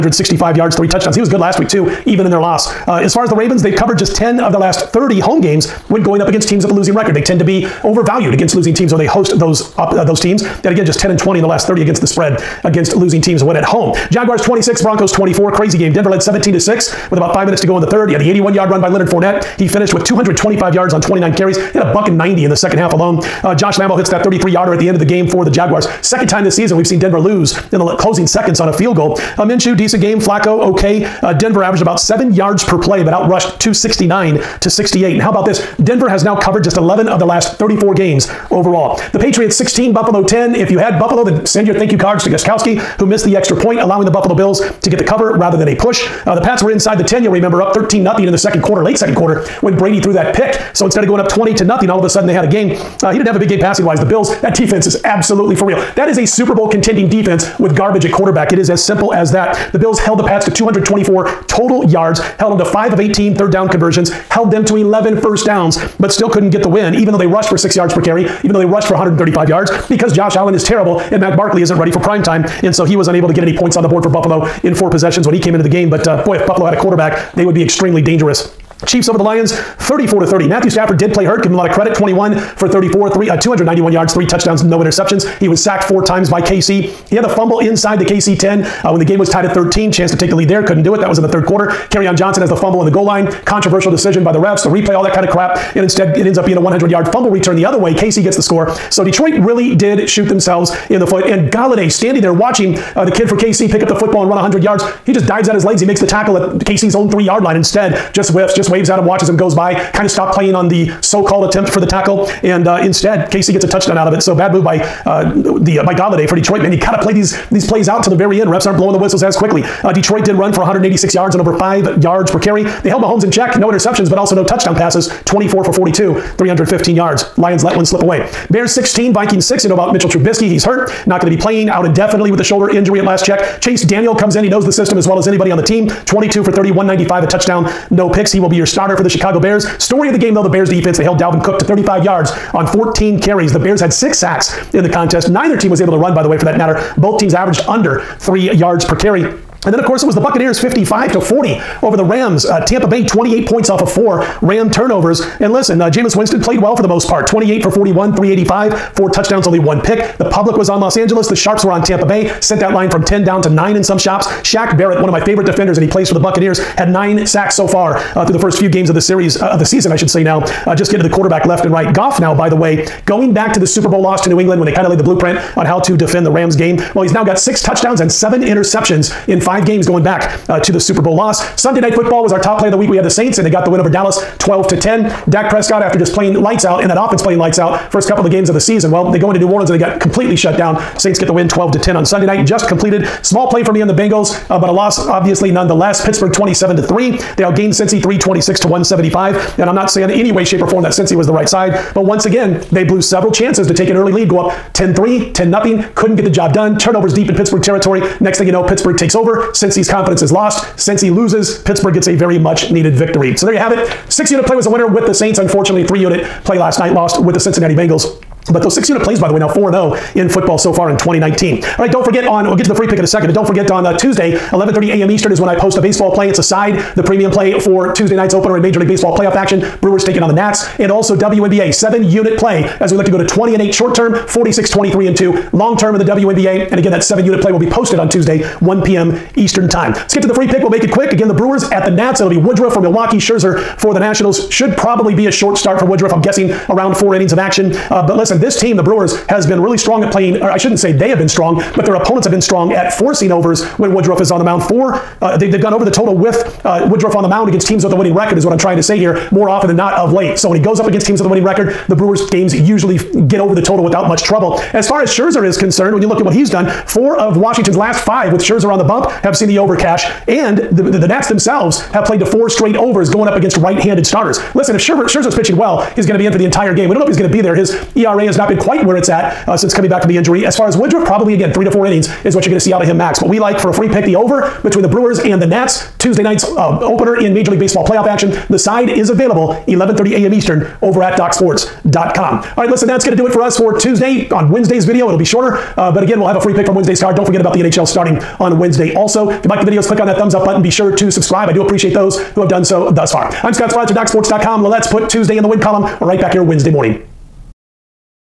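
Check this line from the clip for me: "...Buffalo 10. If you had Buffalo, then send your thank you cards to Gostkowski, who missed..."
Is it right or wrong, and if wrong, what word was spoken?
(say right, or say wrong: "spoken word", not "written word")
right.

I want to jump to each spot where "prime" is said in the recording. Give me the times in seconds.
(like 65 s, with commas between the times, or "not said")
71 s.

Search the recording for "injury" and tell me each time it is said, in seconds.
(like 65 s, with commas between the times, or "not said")
132 s, 280 s.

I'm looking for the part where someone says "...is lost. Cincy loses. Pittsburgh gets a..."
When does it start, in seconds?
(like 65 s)
210 s.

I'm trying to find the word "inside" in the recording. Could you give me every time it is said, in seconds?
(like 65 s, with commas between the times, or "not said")
46 s, 87 s.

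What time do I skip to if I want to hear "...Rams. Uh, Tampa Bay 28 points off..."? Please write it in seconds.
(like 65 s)
152 s.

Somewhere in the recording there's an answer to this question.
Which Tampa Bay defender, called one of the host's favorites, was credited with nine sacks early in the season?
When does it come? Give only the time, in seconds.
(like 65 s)
164 s.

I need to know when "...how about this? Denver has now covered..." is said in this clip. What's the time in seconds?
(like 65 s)
35 s.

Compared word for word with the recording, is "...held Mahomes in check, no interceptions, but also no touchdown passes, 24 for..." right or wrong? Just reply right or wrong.
right.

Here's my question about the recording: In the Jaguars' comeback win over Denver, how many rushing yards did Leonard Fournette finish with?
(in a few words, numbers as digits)
225.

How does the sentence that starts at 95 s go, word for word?
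And instead, it ends up being a 100 yard fumble return the other way.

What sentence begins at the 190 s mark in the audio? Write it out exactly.
Saints get the win 12 to 10 on Sunday night.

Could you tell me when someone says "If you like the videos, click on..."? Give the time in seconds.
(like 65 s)
299 s.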